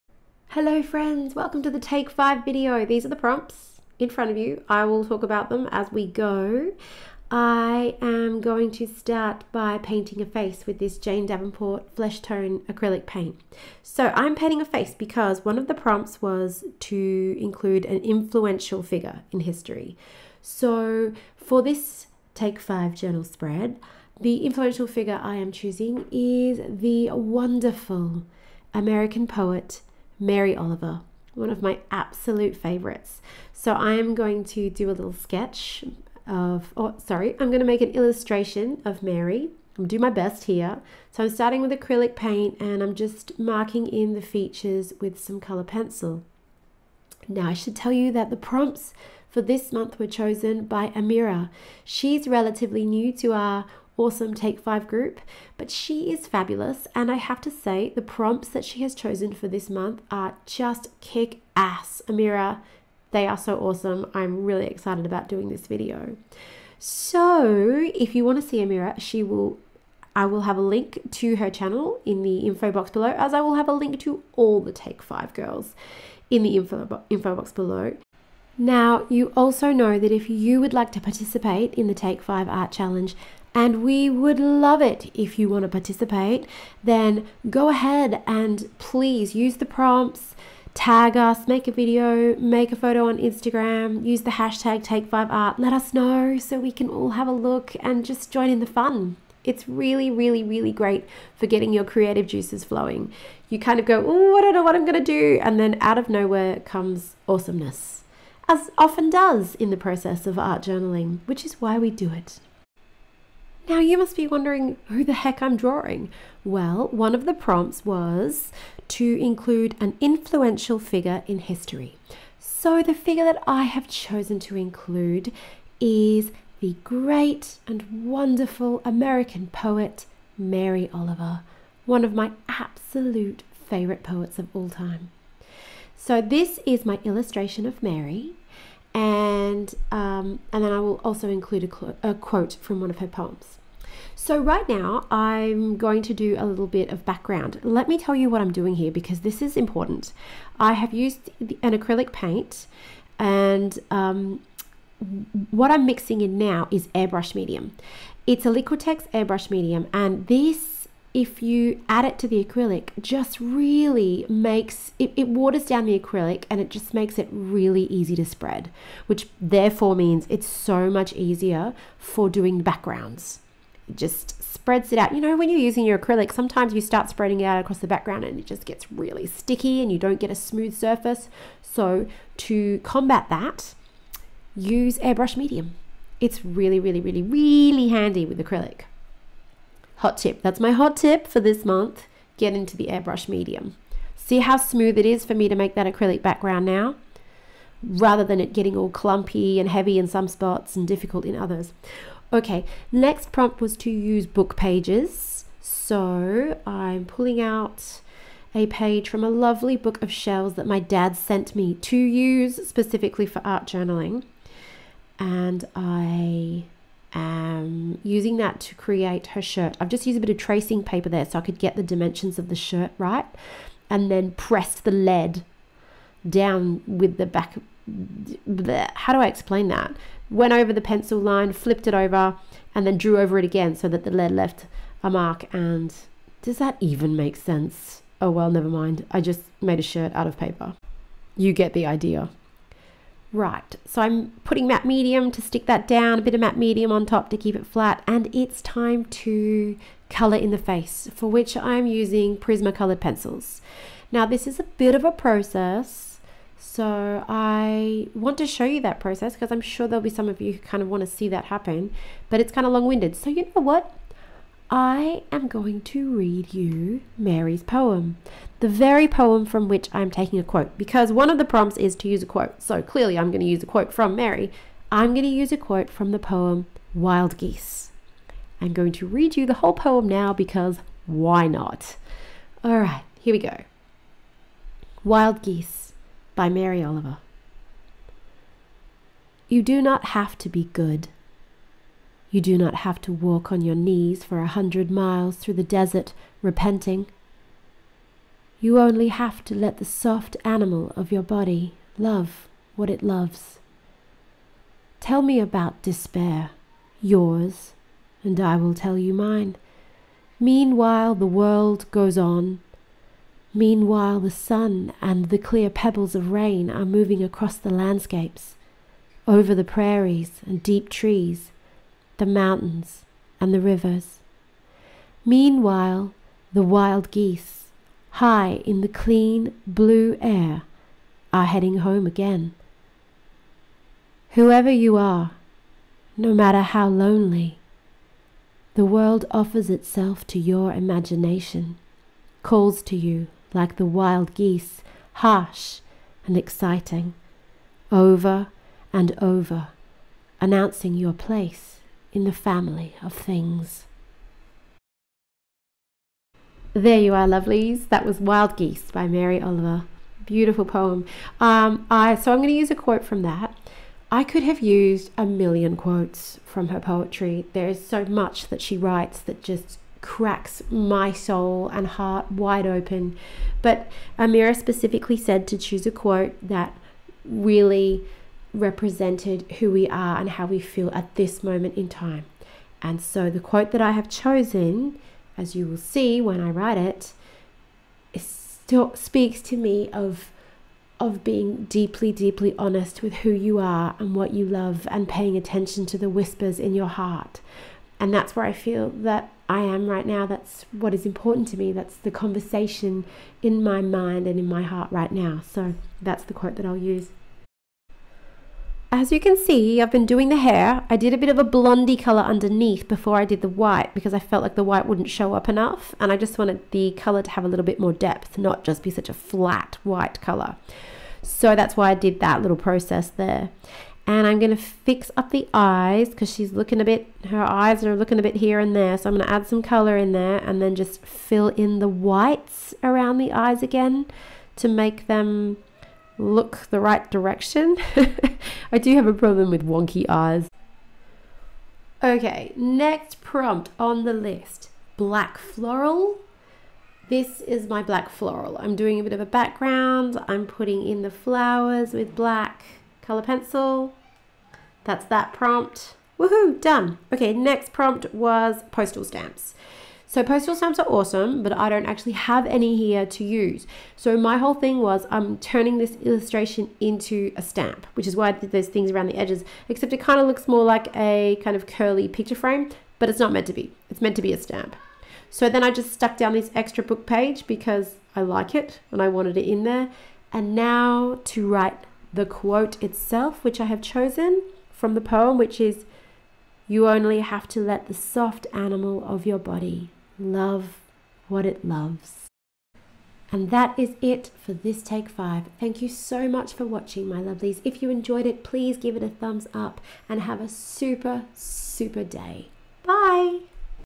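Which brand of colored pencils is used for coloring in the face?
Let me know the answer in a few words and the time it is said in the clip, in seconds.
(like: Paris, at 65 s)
Prismacolor, at 252 s.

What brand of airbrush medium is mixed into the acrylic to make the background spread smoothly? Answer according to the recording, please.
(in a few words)
Liquitex.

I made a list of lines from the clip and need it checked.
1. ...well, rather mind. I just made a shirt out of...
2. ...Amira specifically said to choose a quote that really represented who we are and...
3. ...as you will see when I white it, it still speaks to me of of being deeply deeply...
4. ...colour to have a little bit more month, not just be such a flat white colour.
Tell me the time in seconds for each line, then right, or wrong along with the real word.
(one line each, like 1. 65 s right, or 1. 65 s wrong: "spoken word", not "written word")
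1. 238 s wrong: "never", not "rather"
2. 374 s right
3. 385 s wrong: "write", not "white"
4. 416 s wrong: "depth", not "month".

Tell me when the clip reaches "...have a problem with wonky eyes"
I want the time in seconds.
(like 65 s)
438 s.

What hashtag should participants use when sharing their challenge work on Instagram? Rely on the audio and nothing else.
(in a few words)
Take5Art.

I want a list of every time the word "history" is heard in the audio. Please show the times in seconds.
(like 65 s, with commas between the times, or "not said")
19 s, 121 s.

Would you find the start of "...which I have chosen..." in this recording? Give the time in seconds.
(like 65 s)
483 s.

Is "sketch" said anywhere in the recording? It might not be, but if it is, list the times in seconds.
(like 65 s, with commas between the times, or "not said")
35 s.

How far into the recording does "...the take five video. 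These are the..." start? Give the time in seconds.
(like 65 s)
1 s.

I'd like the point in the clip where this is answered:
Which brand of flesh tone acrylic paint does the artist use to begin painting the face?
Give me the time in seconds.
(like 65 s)
10 s.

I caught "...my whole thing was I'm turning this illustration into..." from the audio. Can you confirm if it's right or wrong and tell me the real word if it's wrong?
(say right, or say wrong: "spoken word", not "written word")
right.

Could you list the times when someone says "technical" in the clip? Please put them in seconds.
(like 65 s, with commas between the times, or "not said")
not said.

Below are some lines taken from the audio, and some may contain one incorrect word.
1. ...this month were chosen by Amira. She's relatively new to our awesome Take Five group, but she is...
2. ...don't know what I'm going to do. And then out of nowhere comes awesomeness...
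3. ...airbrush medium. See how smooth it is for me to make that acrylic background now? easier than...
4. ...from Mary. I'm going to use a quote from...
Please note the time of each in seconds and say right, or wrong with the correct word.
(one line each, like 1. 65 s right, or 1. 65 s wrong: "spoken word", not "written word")
1. 49 s right
2. 104 s right
3. 192 s wrong: "rather", not "easier"
4. 273 s right.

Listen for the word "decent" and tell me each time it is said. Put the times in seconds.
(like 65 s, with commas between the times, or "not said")
not said.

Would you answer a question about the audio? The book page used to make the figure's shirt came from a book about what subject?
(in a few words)
Shells.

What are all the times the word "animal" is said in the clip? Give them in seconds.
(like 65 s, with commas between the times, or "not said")
300 s, 488 s.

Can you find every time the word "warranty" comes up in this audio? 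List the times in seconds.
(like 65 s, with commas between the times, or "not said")
not said.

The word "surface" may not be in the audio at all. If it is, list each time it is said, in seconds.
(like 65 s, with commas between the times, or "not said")
180 s.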